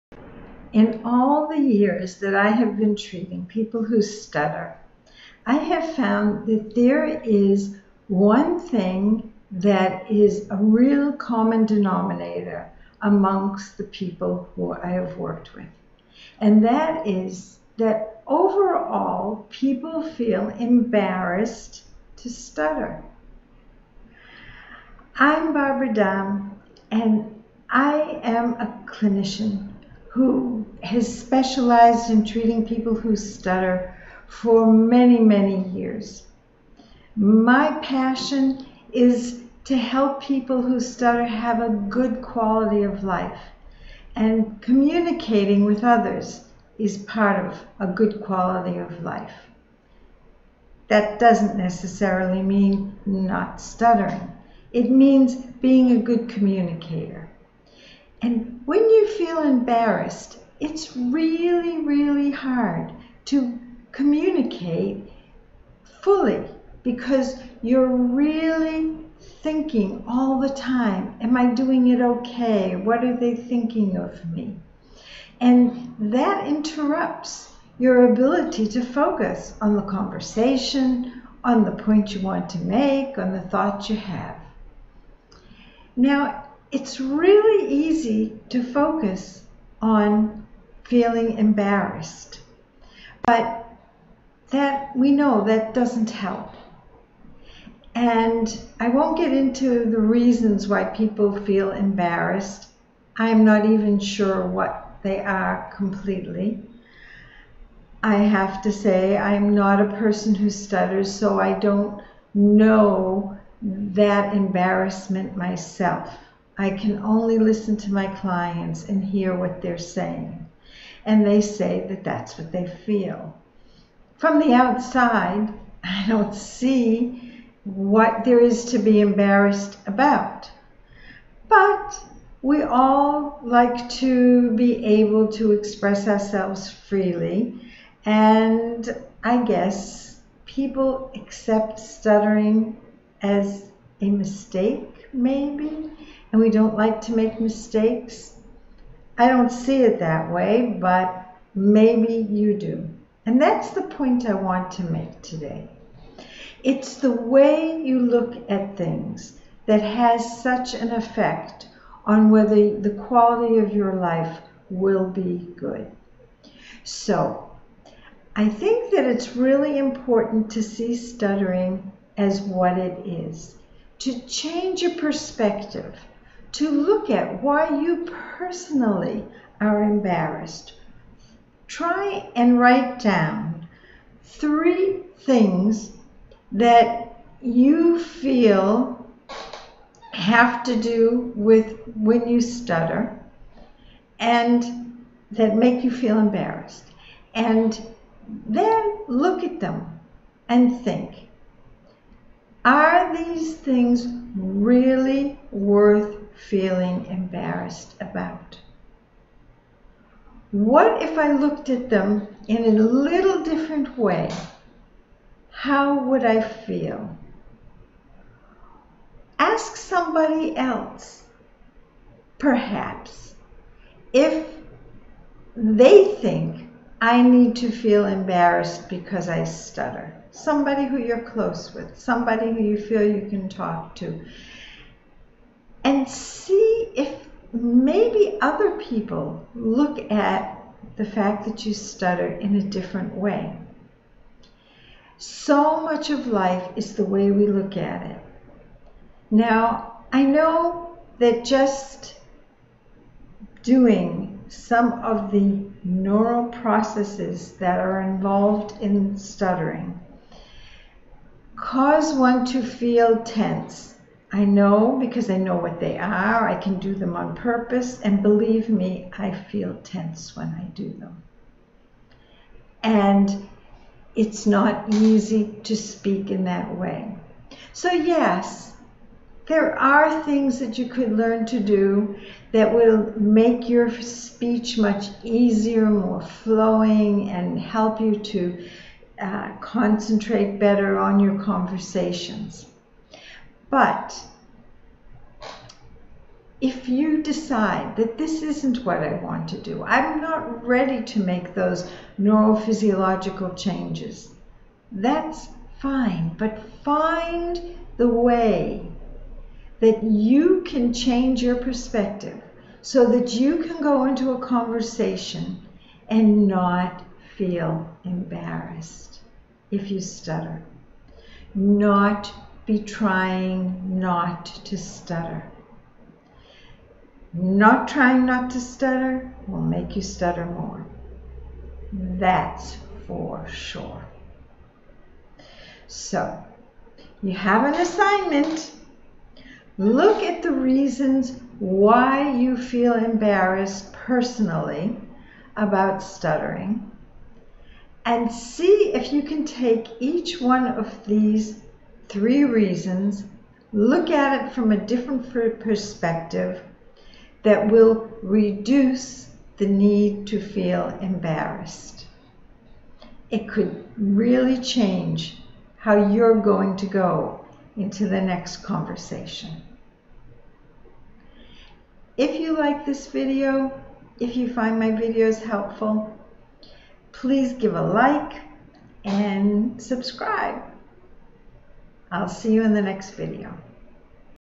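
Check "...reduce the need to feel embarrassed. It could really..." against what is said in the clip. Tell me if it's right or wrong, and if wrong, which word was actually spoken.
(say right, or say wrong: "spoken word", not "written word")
right.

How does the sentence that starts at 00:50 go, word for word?
That doesn't necessarily mean not stuttering.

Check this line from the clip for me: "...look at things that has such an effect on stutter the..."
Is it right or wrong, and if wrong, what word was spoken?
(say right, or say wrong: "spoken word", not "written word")
wrong: "whether", not "stutter".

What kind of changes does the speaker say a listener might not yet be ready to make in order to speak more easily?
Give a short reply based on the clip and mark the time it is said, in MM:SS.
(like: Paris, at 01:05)
neurophysiological, at 05:02.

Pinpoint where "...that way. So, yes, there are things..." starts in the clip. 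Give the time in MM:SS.
04:36.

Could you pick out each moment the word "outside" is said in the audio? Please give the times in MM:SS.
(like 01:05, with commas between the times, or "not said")
02:04.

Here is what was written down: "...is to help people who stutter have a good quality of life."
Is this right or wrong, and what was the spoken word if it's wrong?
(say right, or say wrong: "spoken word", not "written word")
right.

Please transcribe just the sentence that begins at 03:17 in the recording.
And then look at them and think are these things really worth feeling embarrassed about?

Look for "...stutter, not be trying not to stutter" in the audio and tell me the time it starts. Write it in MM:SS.
05:20.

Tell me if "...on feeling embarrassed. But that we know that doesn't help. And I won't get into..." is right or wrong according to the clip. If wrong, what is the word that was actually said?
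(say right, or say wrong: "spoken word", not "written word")
right.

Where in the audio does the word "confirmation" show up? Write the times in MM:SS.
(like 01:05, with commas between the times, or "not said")
not said.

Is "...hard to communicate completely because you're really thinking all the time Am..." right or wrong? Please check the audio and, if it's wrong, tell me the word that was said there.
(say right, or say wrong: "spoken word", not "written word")
wrong: "fully", not "completely".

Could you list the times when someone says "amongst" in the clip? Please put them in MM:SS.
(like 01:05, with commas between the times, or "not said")
00:13.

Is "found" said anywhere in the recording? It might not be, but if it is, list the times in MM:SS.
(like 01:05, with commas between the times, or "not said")
00:05.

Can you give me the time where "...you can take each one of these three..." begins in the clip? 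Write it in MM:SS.
05:49.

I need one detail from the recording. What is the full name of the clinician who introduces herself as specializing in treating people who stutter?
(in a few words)
Barbara Dahm.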